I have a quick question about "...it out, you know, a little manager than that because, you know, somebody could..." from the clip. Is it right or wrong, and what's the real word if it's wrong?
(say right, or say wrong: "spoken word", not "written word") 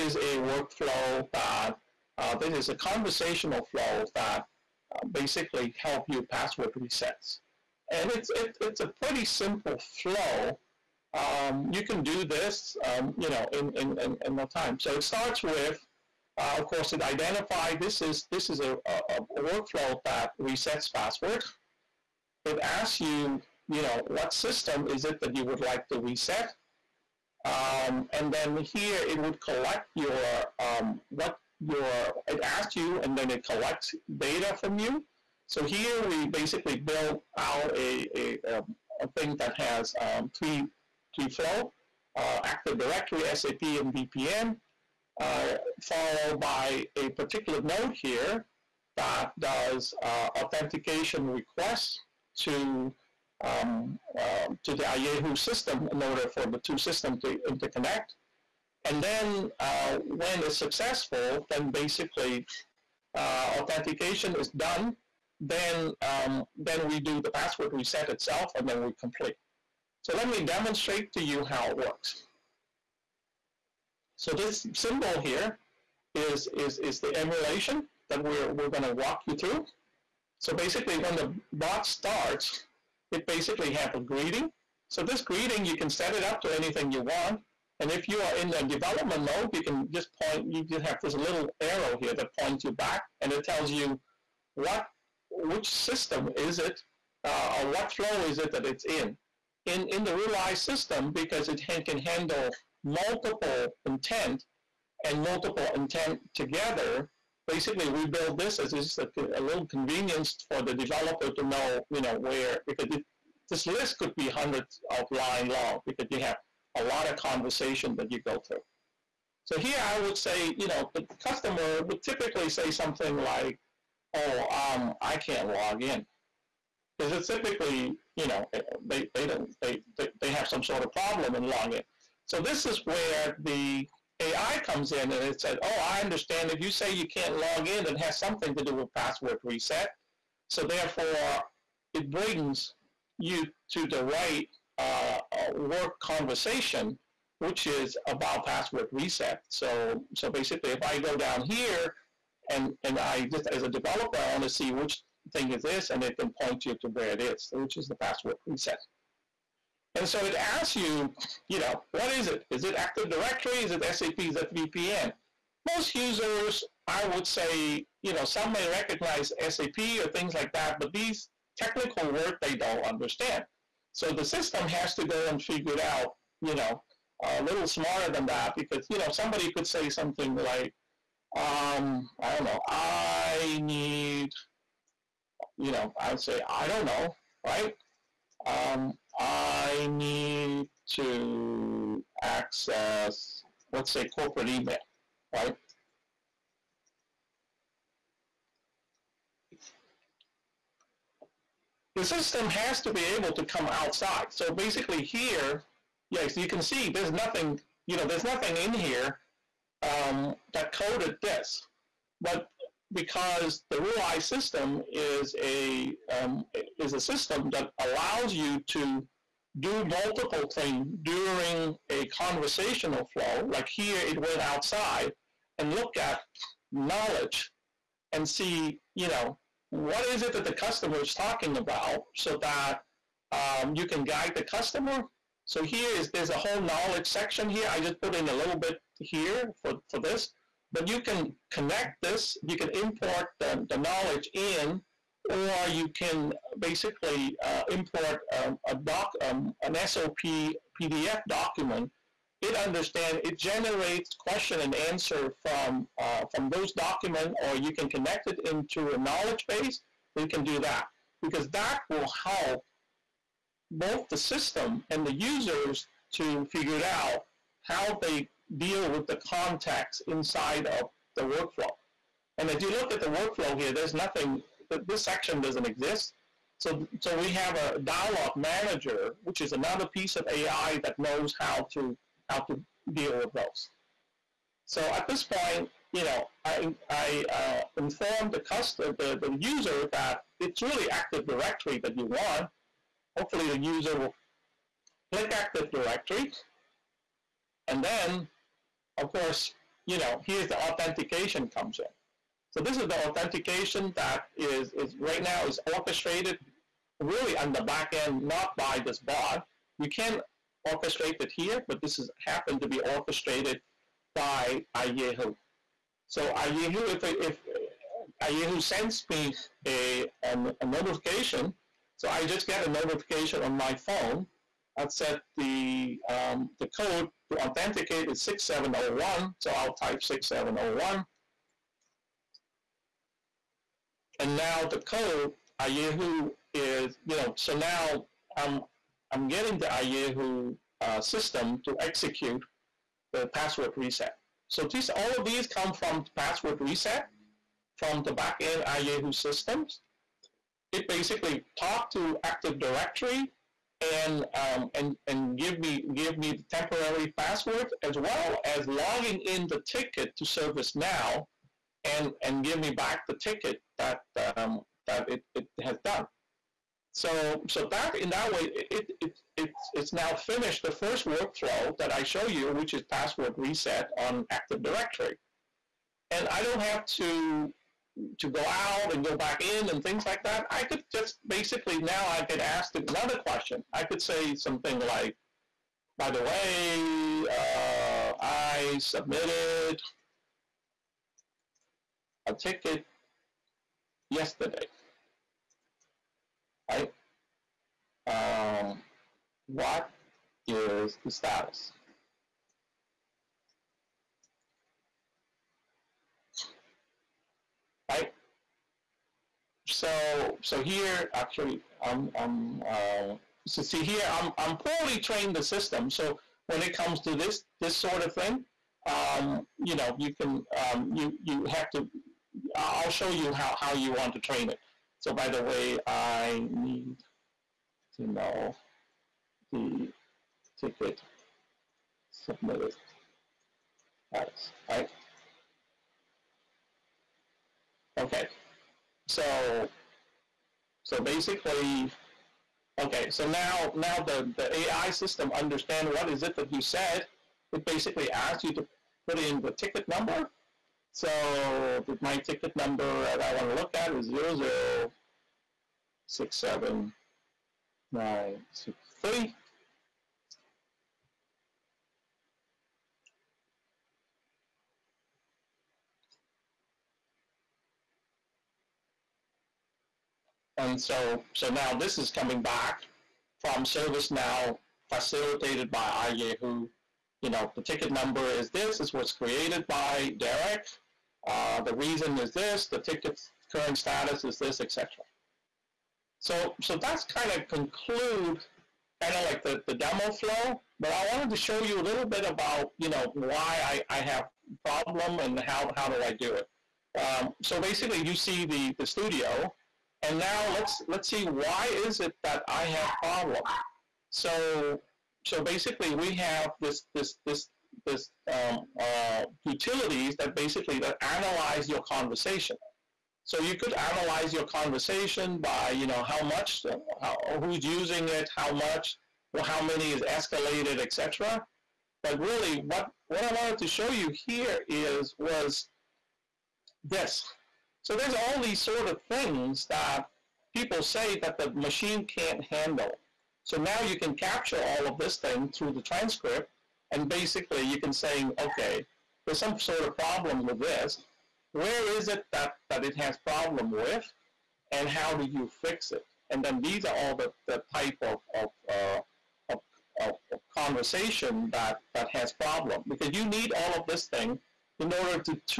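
wrong: "smarter", not "manager".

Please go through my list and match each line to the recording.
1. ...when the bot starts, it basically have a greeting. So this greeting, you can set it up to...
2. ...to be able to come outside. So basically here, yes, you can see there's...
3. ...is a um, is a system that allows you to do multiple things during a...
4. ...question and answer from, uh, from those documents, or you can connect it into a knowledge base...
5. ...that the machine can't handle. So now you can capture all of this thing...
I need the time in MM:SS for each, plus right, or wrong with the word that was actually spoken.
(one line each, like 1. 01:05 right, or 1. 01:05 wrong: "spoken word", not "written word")
1. 01:20 right
2. 03:22 right
3. 03:34 right
4. 04:14 right
5. 08:51 right.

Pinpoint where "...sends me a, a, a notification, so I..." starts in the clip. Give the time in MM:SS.
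05:18.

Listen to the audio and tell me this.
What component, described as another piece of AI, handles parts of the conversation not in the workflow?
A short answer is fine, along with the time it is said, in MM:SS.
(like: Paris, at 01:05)
dialogue manager, at 04:37.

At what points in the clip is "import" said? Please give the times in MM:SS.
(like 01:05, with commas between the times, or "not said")
04:02, 04:07.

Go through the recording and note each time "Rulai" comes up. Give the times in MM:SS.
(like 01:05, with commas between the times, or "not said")
01:40, 03:33.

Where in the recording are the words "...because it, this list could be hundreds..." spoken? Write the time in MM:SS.
01:52.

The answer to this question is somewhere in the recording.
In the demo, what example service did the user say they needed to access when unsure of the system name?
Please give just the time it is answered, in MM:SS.
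03:14.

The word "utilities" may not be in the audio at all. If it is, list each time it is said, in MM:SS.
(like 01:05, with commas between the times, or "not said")
08:29.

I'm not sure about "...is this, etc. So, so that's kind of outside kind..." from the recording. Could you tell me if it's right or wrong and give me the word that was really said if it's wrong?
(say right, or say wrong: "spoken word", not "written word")
wrong: "conclude", not "outside".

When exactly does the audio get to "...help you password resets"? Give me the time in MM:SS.
00:05.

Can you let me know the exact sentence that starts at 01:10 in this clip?
So let me demonstrate to you how it works.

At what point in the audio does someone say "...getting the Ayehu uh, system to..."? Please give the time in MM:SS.
05:39.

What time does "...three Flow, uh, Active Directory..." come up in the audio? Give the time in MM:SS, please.
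00:40.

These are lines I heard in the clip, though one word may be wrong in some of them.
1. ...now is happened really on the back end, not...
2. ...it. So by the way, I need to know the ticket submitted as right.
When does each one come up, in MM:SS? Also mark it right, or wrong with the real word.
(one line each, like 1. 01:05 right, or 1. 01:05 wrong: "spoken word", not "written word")
1. 05:05 wrong: "orchestrated", not "happened"
2. 07:04 right.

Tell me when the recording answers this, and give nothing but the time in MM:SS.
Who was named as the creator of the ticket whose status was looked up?
08:00.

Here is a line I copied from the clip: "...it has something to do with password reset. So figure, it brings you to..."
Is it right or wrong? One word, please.
wrong.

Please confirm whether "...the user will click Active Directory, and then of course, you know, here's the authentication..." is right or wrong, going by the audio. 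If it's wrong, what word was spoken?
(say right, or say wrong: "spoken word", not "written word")
right.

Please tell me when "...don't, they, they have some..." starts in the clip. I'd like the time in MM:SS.
02:09.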